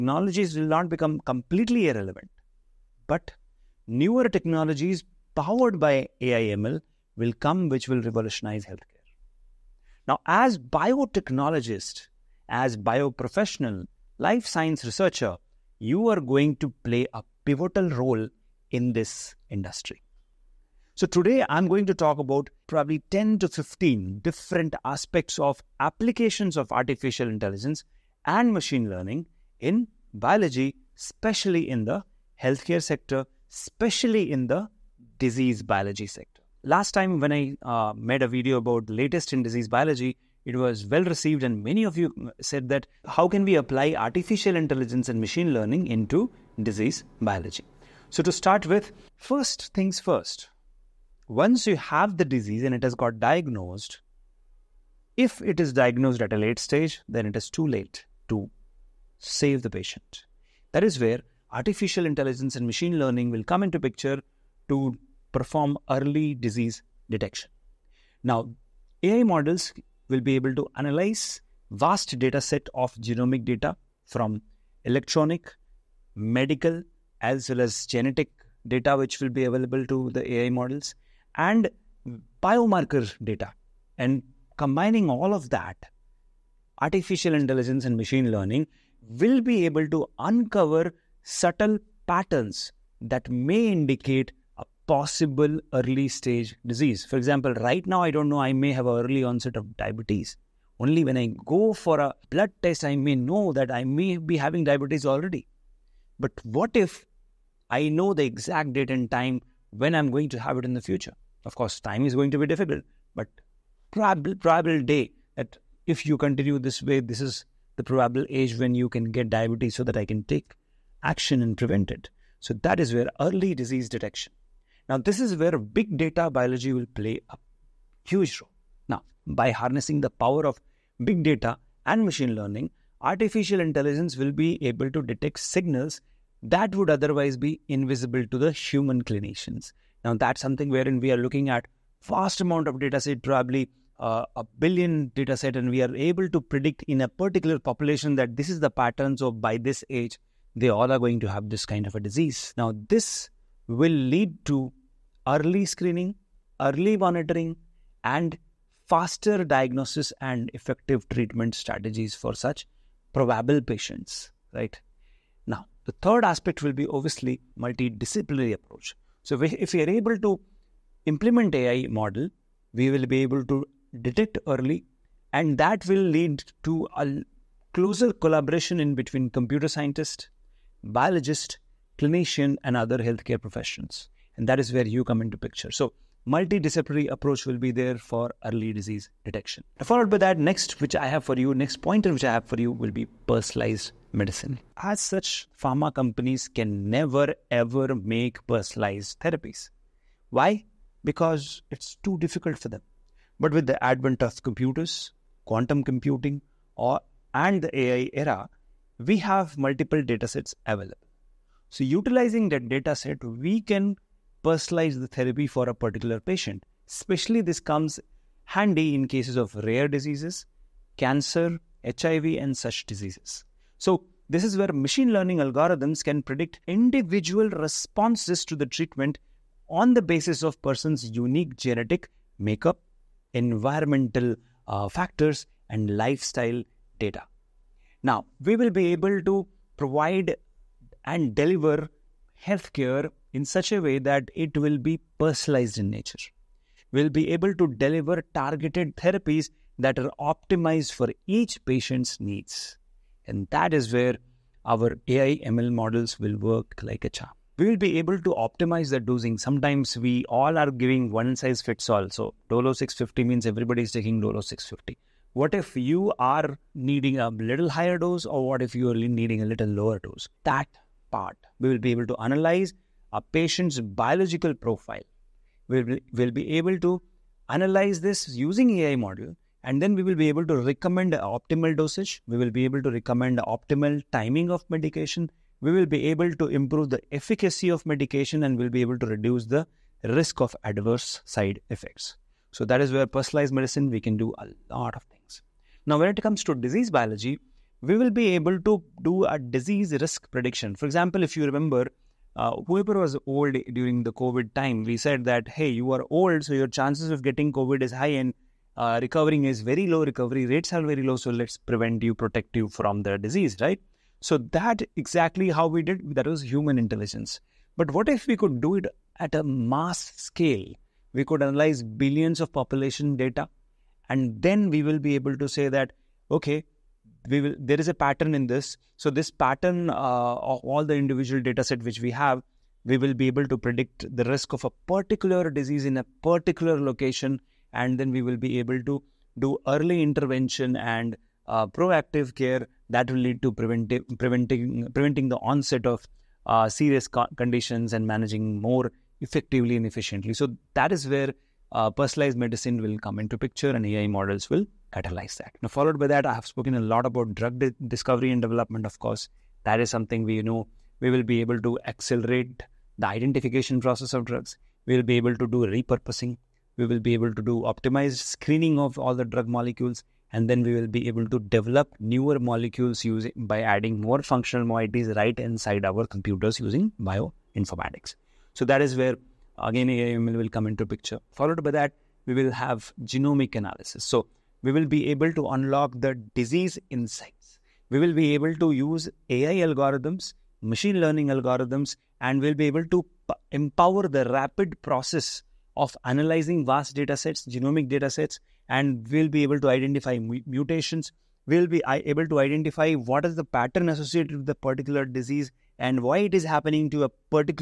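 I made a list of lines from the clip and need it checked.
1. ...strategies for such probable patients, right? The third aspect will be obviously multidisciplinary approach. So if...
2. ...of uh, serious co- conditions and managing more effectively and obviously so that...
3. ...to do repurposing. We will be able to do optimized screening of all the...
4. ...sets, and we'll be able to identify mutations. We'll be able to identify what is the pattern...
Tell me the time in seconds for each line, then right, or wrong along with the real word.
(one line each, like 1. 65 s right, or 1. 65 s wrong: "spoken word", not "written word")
1. 161 s right
2. 345 s wrong: "efficiently", not "obviously"
3. 365 s right
4. 398 s right.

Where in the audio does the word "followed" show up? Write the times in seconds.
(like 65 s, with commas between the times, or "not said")
189 s, 355 s, 381 s.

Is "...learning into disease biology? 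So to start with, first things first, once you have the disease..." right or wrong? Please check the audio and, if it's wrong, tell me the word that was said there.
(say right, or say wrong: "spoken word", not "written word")
right.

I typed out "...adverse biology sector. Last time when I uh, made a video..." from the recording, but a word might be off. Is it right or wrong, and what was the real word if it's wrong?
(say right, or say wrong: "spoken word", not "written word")
wrong: "disease", not "adverse".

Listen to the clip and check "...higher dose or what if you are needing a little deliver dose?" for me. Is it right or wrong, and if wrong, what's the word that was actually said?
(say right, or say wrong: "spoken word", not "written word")
wrong: "lower", not "deliver".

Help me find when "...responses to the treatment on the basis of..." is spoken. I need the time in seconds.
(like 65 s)
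227 s.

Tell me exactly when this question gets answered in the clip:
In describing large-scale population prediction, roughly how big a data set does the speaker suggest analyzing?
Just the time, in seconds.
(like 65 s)
144 s.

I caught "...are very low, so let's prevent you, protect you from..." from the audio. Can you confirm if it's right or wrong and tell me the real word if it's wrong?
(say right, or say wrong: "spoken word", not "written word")
right.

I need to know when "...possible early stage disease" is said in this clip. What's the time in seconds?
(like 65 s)
94 s.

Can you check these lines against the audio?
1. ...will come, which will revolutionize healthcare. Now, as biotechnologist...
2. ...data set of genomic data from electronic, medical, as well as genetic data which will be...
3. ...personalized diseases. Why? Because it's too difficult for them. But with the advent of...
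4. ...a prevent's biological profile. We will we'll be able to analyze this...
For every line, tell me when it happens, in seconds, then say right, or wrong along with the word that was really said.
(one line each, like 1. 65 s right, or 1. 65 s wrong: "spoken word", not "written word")
1. 7 s right
2. 72 s right
3. 198 s wrong: "therapies", not "diseases"
4. 273 s wrong: "patient", not "prevent".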